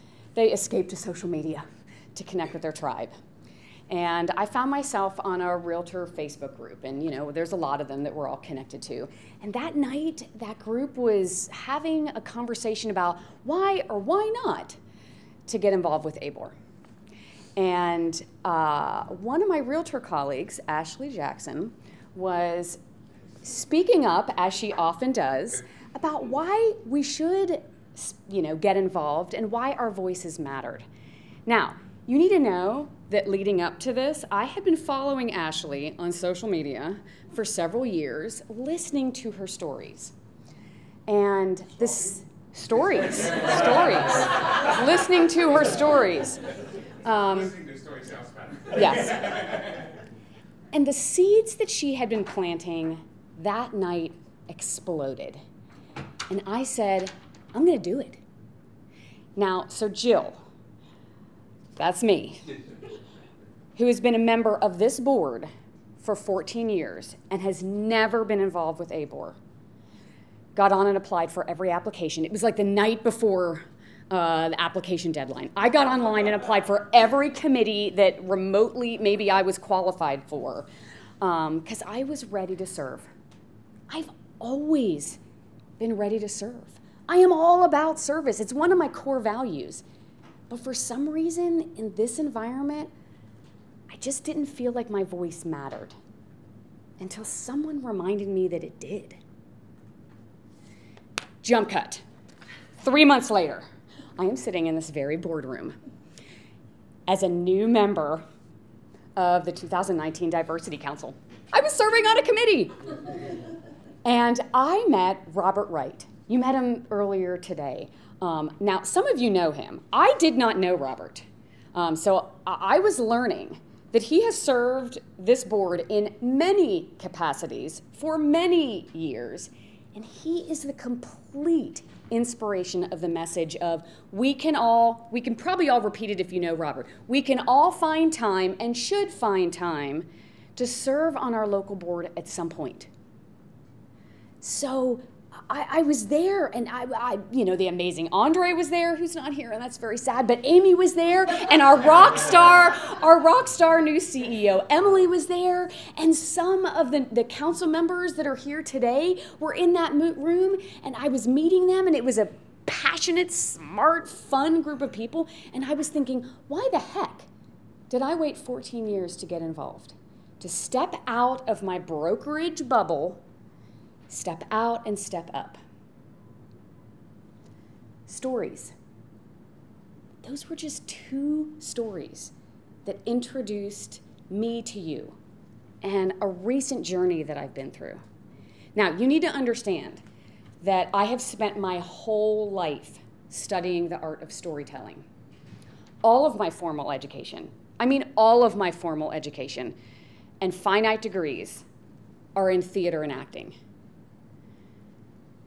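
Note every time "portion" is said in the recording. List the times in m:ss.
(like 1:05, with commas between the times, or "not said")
not said.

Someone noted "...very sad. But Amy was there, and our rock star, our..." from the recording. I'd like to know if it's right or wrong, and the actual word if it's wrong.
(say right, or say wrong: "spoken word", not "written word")
right.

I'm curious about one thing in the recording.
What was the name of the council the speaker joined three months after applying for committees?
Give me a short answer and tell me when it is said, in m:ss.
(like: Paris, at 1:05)
2019 Diversity Council, at 1:49.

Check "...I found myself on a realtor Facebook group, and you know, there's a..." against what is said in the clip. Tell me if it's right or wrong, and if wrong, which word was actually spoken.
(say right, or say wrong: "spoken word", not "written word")
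right.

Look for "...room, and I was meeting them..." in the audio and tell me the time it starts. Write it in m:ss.
2:39.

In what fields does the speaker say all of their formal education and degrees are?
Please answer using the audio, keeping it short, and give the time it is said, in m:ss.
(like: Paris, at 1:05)
Theater and acting, at 3:22.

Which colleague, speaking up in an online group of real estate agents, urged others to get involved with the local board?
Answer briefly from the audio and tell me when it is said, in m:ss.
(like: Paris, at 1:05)
Ashley Jackson, at 0:20.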